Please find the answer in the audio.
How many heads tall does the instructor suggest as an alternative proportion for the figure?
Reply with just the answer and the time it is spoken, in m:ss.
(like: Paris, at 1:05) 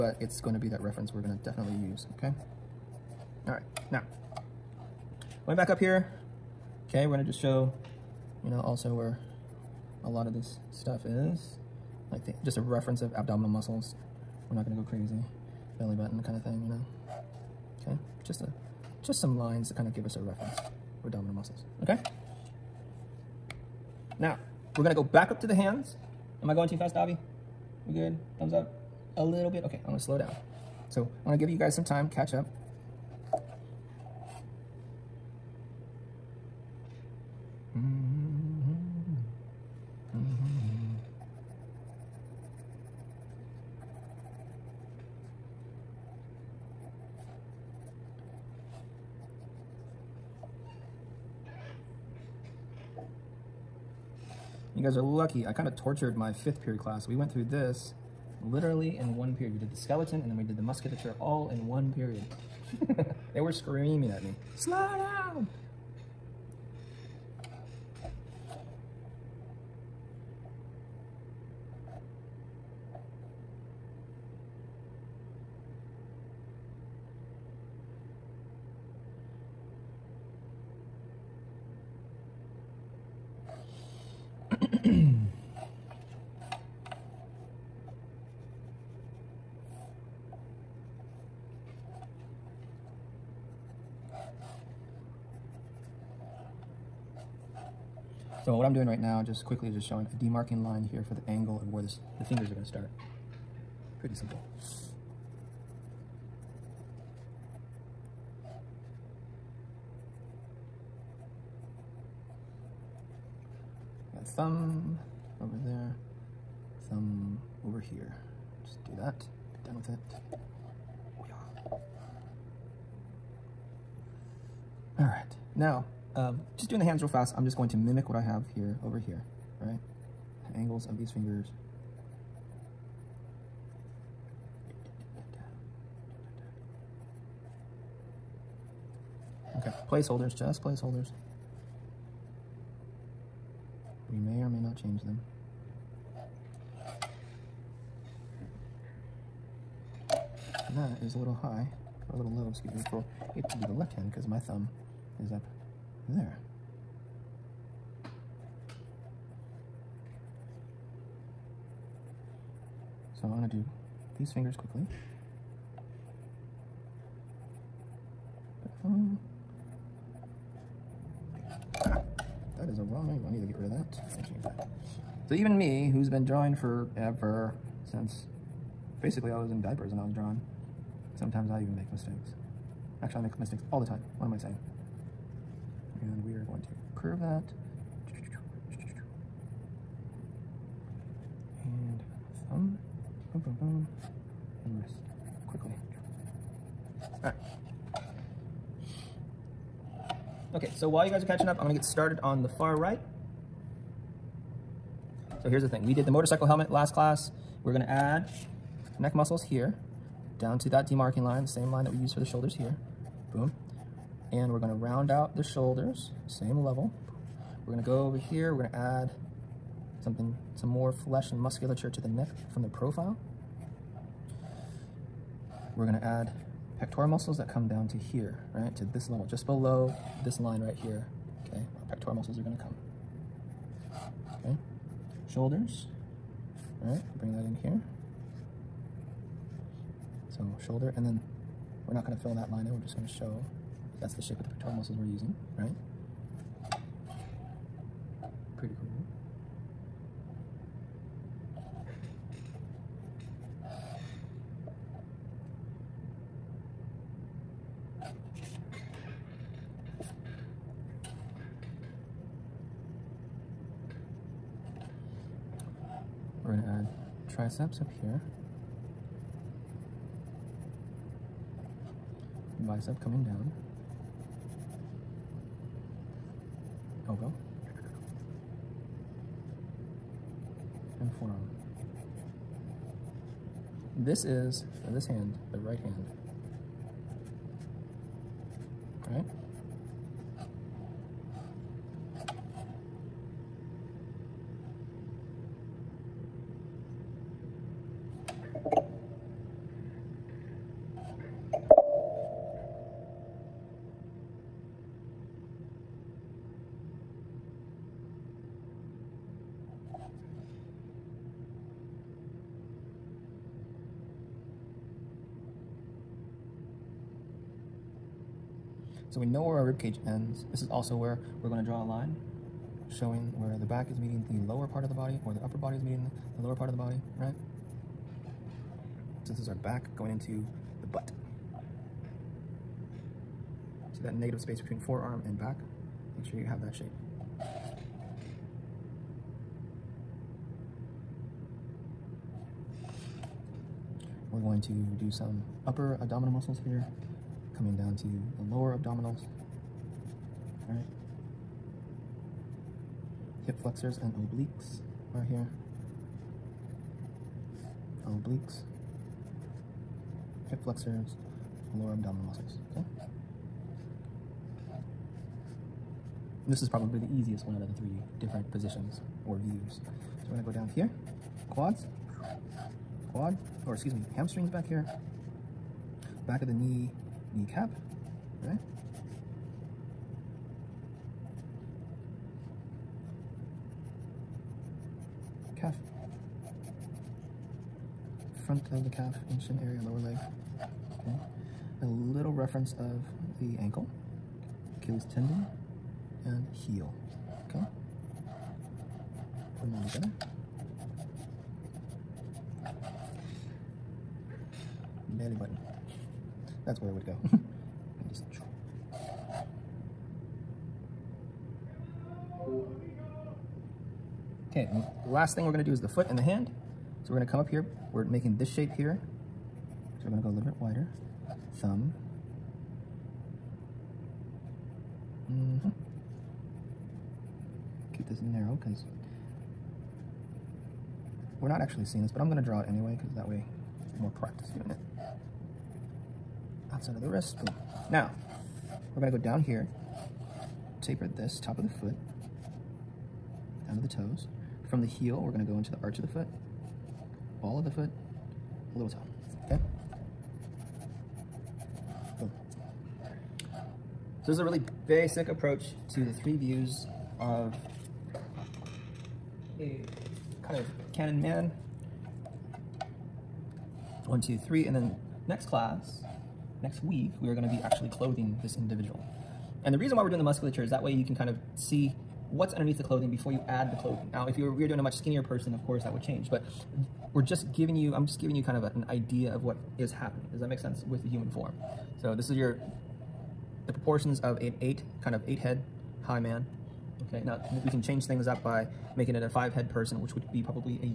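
5, at 8:09.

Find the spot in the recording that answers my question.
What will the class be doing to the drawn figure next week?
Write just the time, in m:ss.
7:47.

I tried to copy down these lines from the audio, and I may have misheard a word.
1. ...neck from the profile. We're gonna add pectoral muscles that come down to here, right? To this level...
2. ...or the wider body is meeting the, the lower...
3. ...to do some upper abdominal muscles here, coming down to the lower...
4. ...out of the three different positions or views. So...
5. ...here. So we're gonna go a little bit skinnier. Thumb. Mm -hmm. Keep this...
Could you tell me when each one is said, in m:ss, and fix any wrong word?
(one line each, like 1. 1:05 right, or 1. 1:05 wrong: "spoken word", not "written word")
1. 3:42 right
2. 5:25 wrong: "upper", not "wider"
3. 5:44 right
4. 6:07 right
5. 6:58 wrong: "wider", not "skinnier".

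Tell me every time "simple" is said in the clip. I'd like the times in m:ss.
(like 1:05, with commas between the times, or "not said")
1:44.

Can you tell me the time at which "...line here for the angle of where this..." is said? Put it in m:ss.
1:40.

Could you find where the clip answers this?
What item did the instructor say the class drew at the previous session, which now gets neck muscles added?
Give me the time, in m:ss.
3:26.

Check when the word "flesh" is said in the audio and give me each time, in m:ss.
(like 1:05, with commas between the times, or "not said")
3:40.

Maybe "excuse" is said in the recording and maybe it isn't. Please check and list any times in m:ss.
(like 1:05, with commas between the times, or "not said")
2:32, 6:13.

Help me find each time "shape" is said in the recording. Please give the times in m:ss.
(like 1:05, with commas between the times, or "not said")
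4:04, 5:36, 6:58.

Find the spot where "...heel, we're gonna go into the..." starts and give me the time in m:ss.
7:24.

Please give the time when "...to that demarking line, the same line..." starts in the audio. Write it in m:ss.
3:30.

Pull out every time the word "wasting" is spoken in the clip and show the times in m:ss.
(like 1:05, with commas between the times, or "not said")
not said.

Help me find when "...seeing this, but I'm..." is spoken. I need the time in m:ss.
7:11.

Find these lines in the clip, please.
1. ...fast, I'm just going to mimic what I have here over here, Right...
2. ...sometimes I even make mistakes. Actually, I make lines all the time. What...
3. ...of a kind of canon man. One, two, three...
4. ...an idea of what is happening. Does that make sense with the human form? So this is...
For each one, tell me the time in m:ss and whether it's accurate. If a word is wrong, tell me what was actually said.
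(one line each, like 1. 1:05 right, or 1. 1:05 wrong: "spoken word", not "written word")
1. 2:07 right
2. 3:01 wrong: "mistakes", not "lines"
3. 7:37 right
4. 7:58 right.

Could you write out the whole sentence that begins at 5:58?
Obliques, hip flexors, lower abdominal muscles.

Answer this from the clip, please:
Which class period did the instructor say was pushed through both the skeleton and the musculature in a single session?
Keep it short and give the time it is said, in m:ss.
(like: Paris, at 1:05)
fifth period, at 0:56.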